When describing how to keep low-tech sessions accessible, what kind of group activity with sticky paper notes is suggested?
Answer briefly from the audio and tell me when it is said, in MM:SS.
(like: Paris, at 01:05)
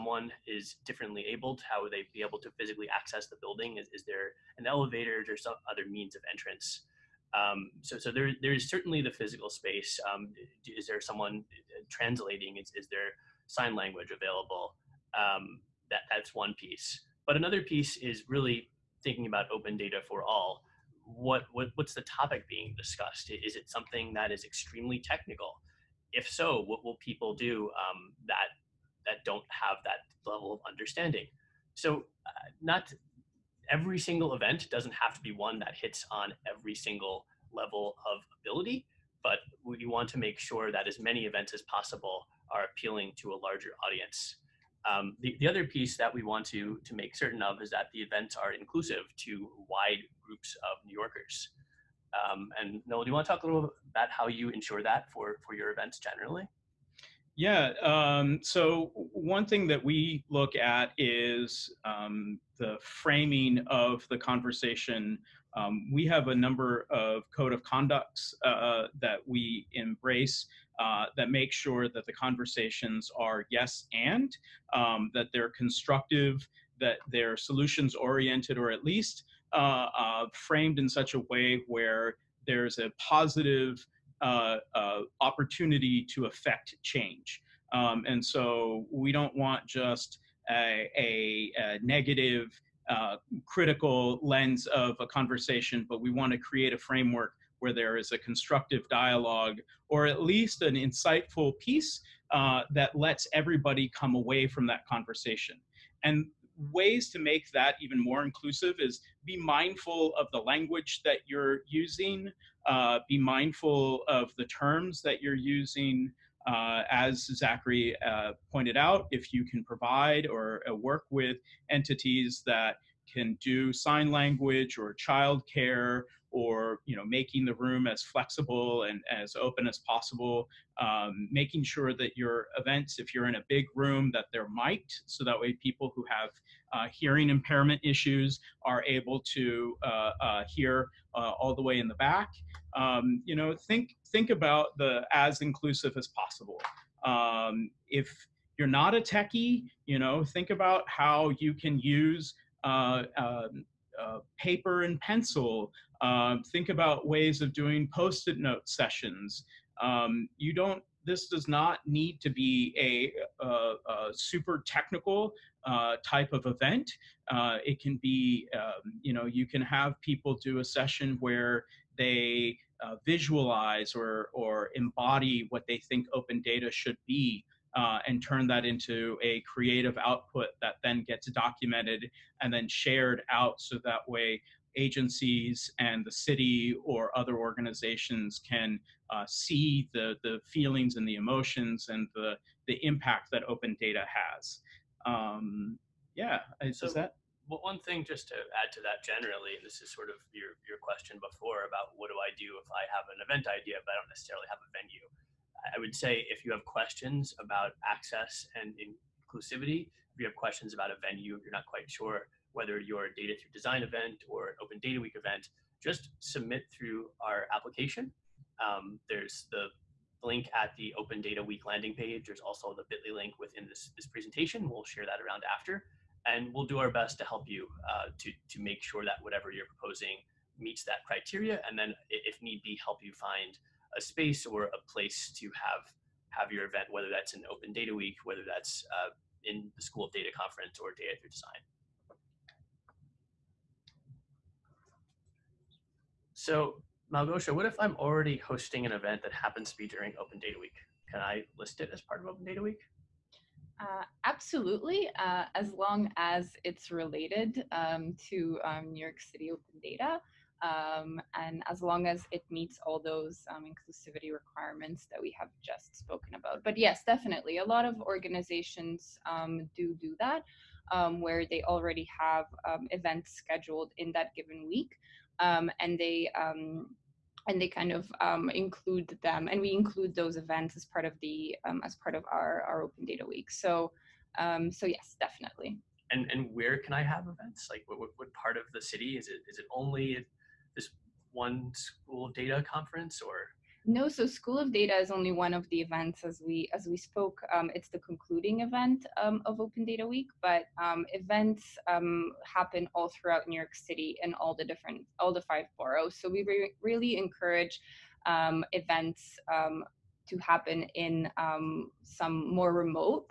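Post-it note sessions, at 02:37.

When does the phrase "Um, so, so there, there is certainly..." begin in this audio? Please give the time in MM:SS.
00:07.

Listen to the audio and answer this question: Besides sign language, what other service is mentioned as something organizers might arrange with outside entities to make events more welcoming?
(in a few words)
Childcare.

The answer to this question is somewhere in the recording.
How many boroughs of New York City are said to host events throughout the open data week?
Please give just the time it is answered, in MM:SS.
05:05.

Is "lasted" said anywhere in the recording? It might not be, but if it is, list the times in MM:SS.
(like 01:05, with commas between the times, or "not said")
not said.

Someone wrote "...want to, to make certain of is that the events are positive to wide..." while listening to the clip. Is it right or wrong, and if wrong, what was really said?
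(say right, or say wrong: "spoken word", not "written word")
wrong: "inclusive", not "positive".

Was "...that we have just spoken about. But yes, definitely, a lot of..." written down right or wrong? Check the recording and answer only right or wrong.
right.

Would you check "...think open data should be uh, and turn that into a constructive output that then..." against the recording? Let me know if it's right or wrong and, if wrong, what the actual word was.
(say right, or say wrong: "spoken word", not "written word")
wrong: "creative", not "constructive".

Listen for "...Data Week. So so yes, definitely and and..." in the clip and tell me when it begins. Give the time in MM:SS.
04:43.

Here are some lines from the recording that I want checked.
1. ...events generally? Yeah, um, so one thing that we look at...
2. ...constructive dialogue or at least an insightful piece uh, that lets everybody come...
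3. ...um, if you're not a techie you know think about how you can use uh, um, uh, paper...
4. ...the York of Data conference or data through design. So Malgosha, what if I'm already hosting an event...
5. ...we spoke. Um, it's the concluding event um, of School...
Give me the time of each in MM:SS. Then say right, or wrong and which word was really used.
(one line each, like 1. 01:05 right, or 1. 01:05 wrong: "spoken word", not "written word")
1. 00:55 right
2. 01:38 right
3. 02:27 right
4. 03:59 wrong: "School", not "York"
5. 04:56 wrong: "Open", not "School".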